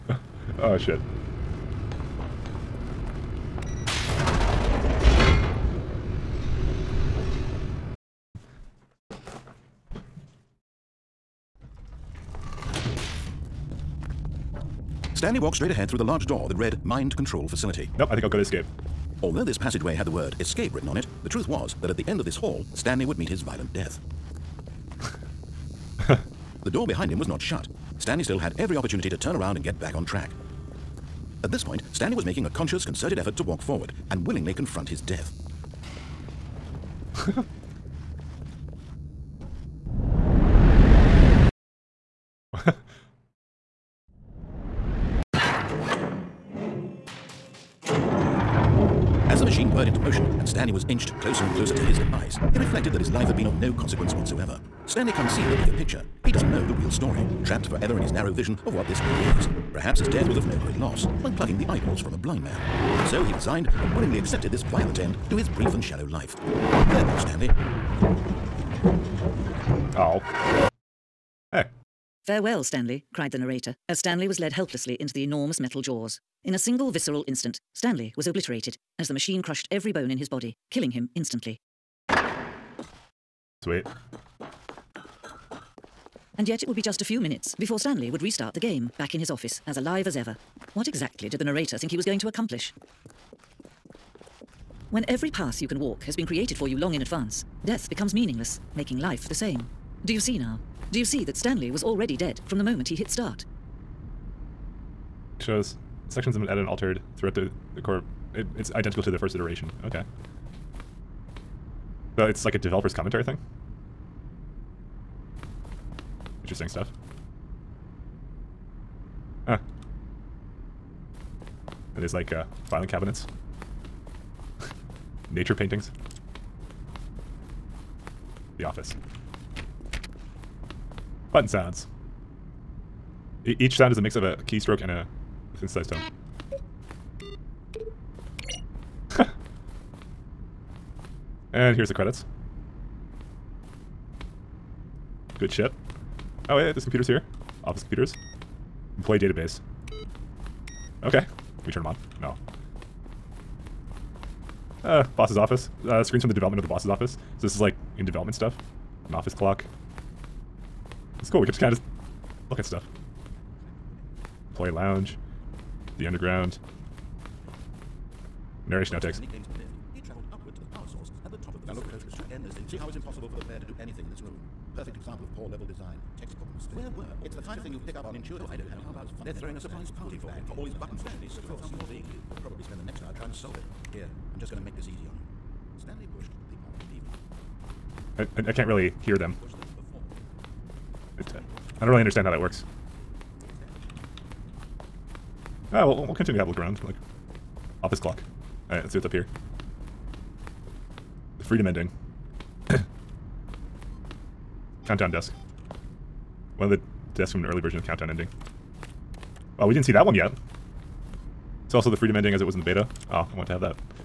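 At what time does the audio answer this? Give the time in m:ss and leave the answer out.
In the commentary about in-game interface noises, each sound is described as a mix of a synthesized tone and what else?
2:14.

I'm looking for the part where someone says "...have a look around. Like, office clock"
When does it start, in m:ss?
3:16.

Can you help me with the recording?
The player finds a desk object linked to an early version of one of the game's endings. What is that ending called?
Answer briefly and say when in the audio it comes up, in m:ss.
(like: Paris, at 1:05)
The countdown ending, at 3:27.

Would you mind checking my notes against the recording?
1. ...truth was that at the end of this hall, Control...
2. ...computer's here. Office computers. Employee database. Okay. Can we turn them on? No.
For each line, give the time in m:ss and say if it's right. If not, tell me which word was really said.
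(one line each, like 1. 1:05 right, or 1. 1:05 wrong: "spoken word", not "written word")
1. 0:21 wrong: "Stanley", not "Control"
2. 2:26 right.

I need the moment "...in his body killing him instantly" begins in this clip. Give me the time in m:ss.
1:20.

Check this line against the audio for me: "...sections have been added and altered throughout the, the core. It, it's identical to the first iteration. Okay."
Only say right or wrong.
right.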